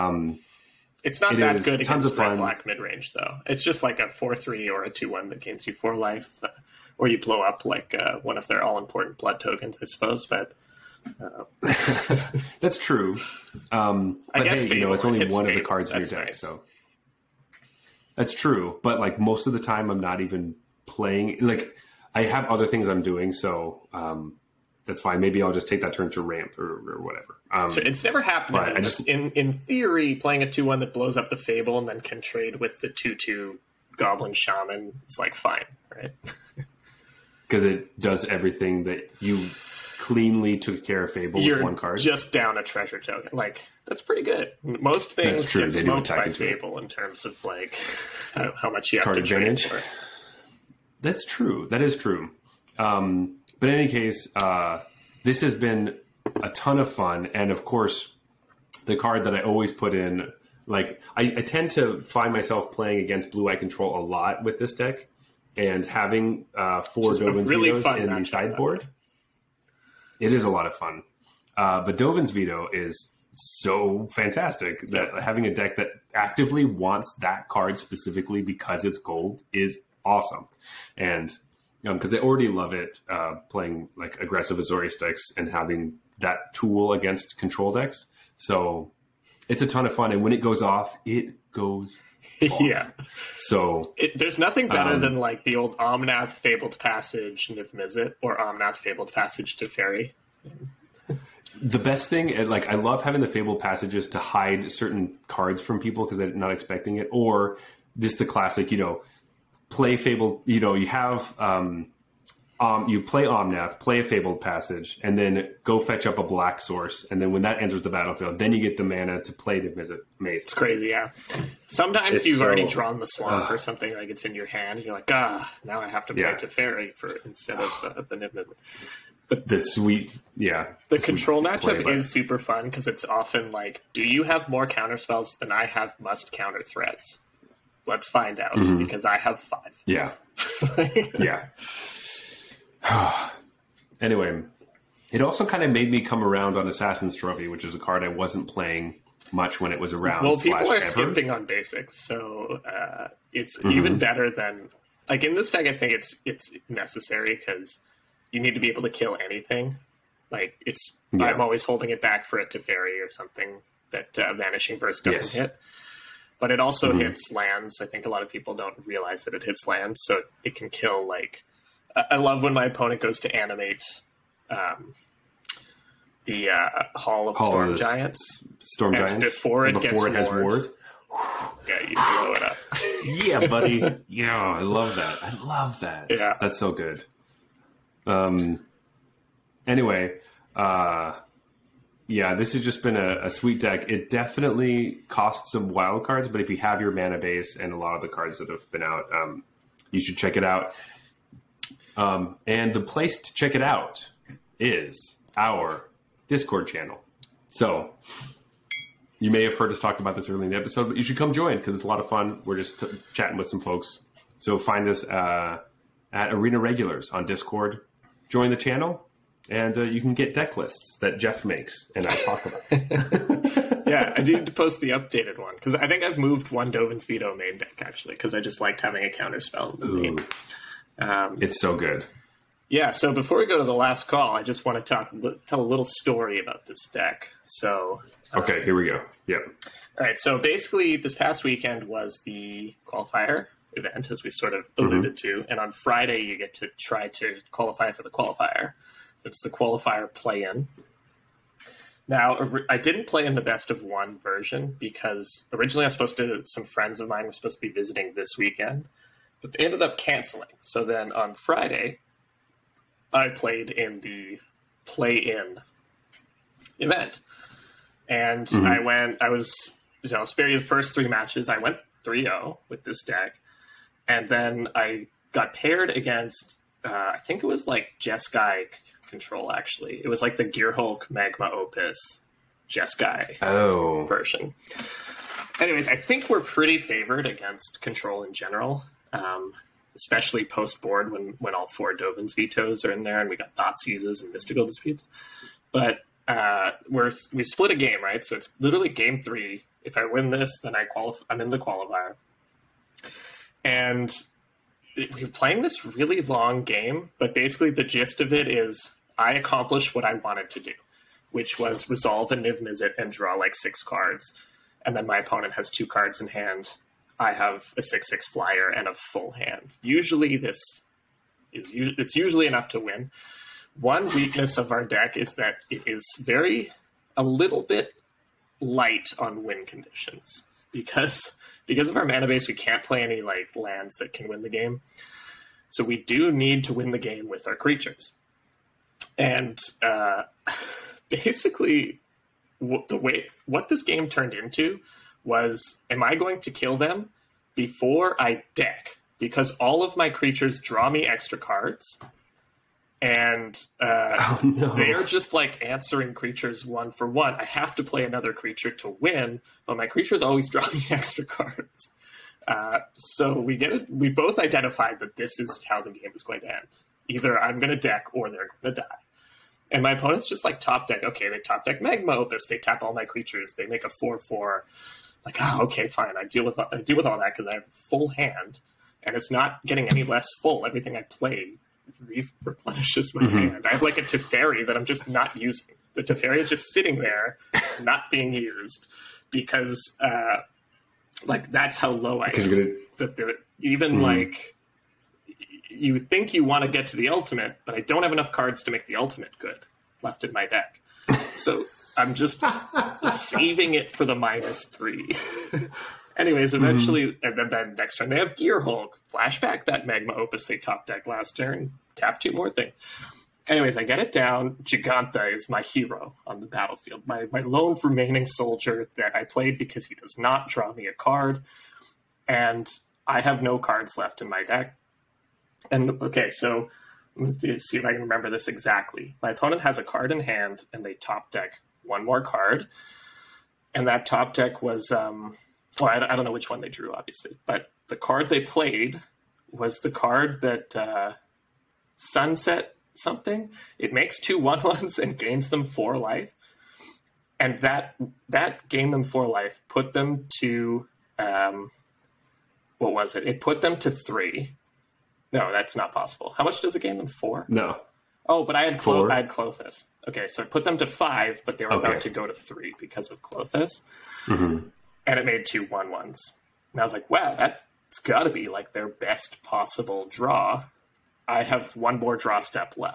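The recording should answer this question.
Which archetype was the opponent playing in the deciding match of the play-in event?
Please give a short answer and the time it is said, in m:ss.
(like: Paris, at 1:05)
Jeskai Control, at 4:37.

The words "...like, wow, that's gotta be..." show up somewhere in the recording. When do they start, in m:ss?
7:46.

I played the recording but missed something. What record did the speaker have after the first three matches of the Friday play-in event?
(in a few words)
3-0.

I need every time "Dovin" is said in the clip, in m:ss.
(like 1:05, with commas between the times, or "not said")
1:07, 1:11, 3:46, 4:51.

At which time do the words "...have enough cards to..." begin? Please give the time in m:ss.
6:38.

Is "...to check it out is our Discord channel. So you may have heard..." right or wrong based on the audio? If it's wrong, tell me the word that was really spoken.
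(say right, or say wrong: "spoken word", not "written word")
right.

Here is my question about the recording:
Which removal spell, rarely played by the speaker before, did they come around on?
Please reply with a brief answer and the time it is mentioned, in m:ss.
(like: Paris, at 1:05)
Assassin's Trophy, at 2:26.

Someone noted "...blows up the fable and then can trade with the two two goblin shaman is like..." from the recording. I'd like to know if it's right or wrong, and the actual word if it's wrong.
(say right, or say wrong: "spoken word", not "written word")
right.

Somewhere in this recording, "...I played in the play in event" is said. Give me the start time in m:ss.
4:23.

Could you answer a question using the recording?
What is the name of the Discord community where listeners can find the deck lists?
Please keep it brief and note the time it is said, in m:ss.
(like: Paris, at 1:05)
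Arena Regulars, at 3:36.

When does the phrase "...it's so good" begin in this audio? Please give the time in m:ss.
3:51.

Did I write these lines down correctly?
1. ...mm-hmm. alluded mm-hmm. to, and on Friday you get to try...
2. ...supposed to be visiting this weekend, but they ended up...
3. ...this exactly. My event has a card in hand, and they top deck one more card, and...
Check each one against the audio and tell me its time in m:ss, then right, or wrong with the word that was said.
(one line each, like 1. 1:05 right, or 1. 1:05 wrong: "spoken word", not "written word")
1. 4:04 right
2. 4:17 right
3. 7:08 wrong: "opponent", not "event".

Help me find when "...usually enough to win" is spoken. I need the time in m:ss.
5:22.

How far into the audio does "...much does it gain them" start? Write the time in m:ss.
7:36.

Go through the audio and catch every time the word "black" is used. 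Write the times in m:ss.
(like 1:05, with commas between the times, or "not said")
0:02, 1:56.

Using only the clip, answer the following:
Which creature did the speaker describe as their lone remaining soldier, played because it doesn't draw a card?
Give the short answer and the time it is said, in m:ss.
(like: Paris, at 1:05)
Jegantha, at 6:54.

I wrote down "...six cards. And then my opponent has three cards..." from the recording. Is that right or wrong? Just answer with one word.
wrong.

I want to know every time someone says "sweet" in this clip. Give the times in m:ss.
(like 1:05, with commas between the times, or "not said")
2:09, 3:13.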